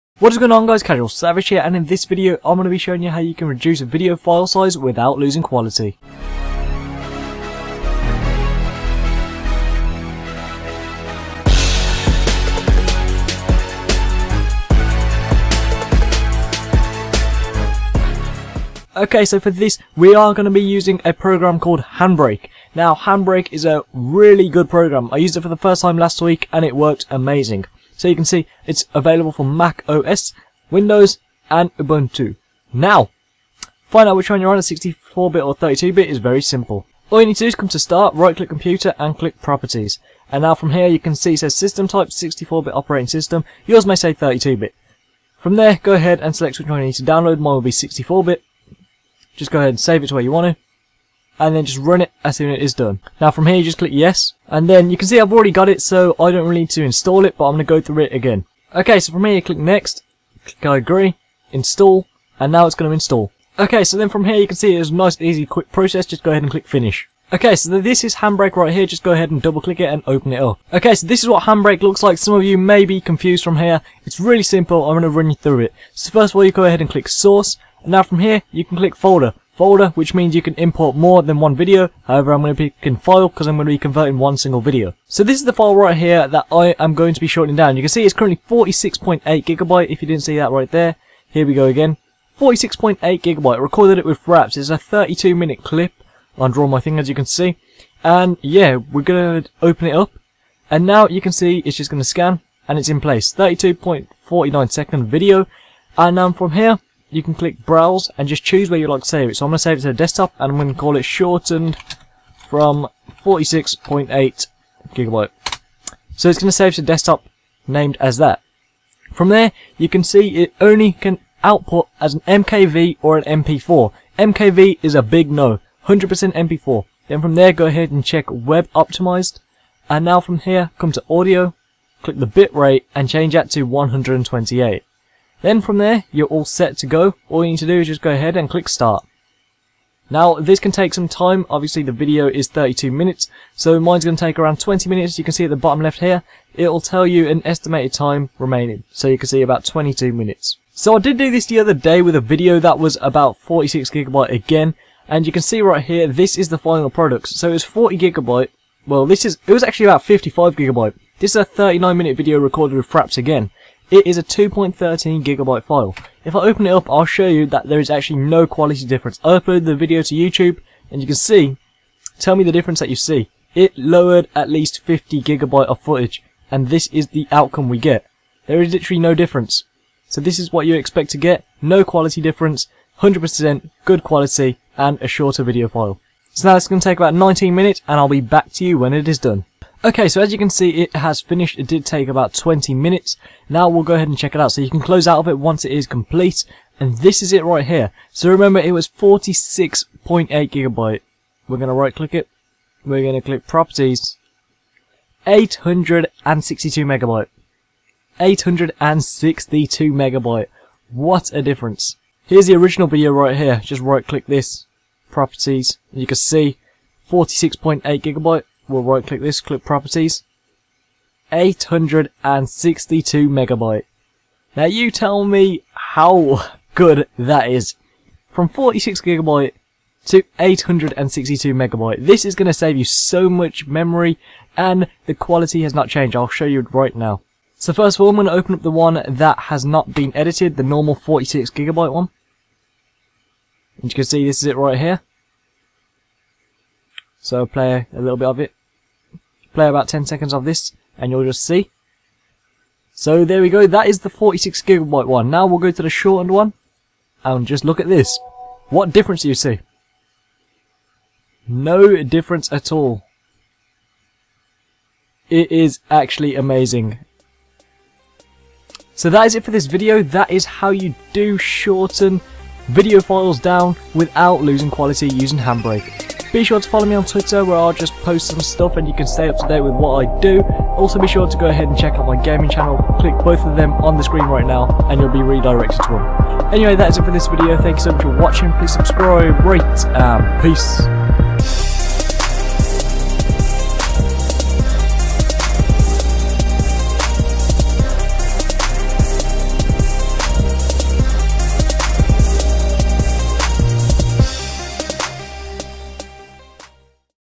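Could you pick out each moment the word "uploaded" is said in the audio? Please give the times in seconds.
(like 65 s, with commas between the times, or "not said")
169 s.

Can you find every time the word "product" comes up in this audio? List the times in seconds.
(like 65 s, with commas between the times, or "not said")
156 s.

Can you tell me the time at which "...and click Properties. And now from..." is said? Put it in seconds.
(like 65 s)
38 s.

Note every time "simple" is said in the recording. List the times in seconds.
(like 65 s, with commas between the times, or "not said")
36 s, 74 s.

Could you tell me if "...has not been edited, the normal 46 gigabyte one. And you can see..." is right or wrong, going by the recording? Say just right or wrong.
right.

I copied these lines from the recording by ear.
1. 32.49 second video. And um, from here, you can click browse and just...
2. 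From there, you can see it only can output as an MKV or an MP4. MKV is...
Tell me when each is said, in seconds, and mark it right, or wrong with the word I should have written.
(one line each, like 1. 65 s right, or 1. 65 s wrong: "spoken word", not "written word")
1. 103 s right
2. 119 s right.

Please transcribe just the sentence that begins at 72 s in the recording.
Some of you may be confused from here.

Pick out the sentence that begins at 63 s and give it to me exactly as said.
Okay so then from here you can see it's a nice easy quick process just go ahead and click finish.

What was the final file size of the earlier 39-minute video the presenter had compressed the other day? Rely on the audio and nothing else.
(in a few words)
2.13 gigabytes.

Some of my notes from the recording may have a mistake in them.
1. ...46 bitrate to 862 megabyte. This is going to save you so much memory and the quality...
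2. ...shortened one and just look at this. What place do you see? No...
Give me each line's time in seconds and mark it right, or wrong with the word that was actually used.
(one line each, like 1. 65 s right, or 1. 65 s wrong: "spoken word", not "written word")
1. 228 s wrong: "gigabyte", not "bitrate"
2. 255 s wrong: "difference", not "place".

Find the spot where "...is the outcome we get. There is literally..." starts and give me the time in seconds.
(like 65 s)
176 s.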